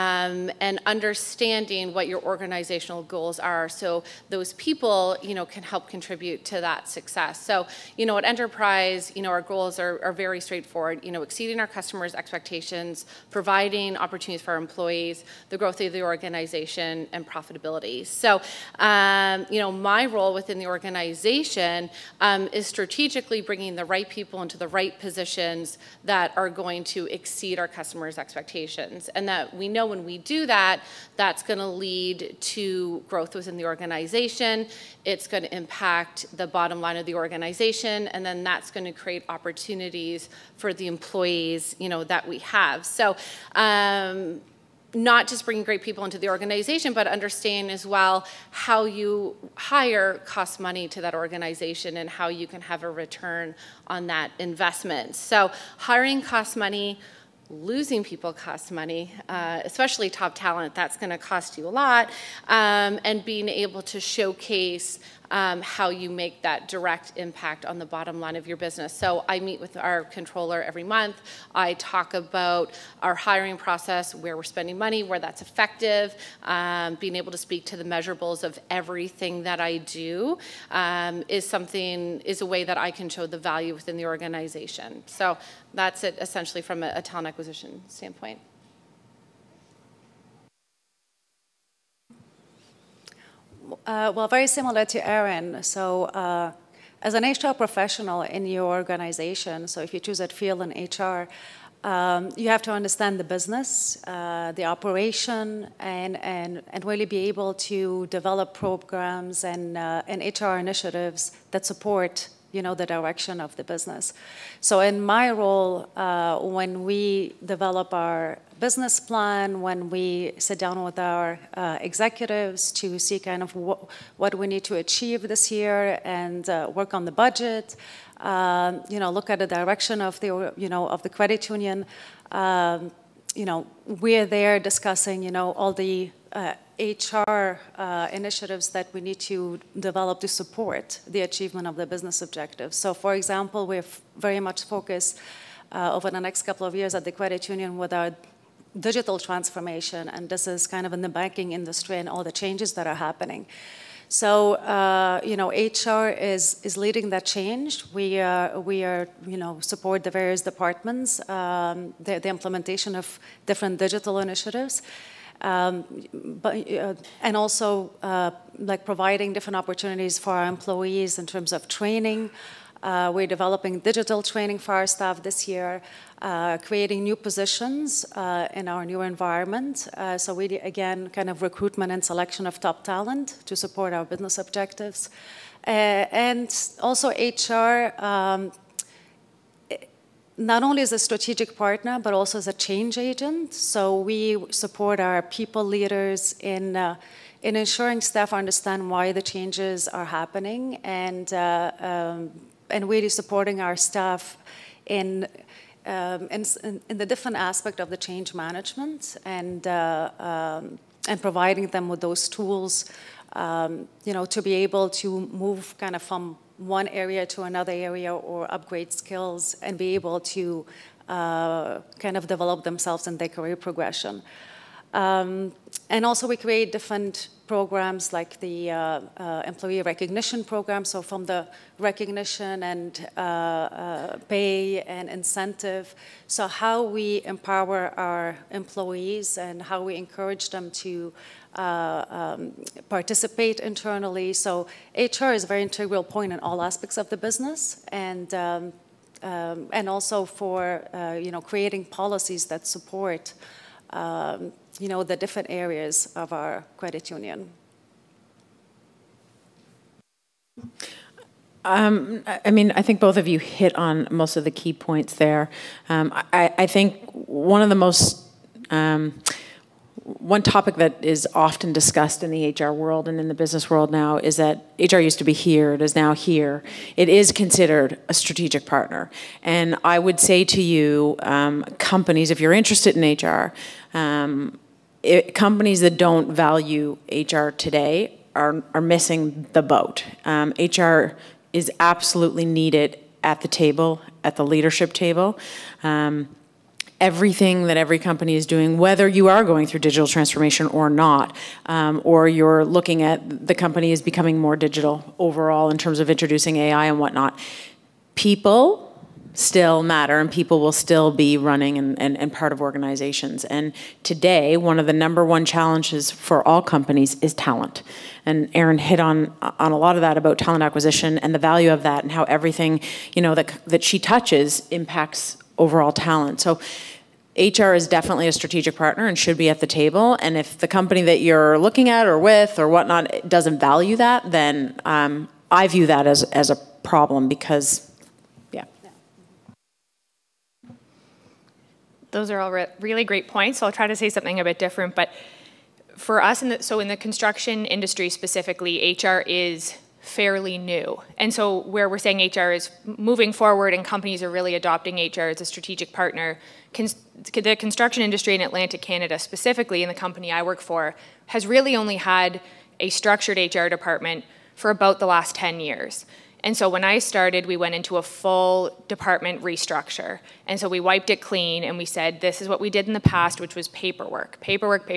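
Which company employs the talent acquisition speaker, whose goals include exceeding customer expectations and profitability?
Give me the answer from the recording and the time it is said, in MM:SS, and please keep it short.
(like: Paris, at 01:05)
Enterprise, at 00:08.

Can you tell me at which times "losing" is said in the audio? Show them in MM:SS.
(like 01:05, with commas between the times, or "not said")
00:57.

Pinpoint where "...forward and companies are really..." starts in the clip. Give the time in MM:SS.
05:53.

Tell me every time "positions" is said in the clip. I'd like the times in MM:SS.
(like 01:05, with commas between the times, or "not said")
00:24, 02:57.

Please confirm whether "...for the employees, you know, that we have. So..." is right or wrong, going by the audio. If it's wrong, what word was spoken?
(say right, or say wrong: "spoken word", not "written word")
right.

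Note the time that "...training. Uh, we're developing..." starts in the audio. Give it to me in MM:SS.
02:51.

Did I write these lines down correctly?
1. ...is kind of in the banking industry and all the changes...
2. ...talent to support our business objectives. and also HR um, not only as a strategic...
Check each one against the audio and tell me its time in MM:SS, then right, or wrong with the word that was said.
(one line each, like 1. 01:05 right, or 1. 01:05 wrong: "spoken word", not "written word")
1. 02:30 right
2. 03:02 right.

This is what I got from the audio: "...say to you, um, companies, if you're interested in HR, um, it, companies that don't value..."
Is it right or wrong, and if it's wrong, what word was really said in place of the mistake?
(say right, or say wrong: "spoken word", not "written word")
right.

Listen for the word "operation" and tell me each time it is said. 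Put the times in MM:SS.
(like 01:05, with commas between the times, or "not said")
01:44.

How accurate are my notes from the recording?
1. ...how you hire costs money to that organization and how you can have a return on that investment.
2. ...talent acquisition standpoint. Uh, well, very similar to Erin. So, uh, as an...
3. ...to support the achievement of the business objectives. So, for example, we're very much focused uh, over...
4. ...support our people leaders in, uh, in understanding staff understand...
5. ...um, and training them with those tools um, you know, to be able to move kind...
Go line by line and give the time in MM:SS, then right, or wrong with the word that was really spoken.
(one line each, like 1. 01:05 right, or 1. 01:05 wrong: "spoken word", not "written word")
1. 00:48 right
2. 01:27 right
3. 02:20 right
4. 03:14 wrong: "ensuring", not "understanding"
5. 03:30 wrong: "providing", not "training".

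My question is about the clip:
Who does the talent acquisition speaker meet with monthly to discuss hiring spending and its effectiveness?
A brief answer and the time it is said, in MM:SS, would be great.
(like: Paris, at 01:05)
controller, at 01:10.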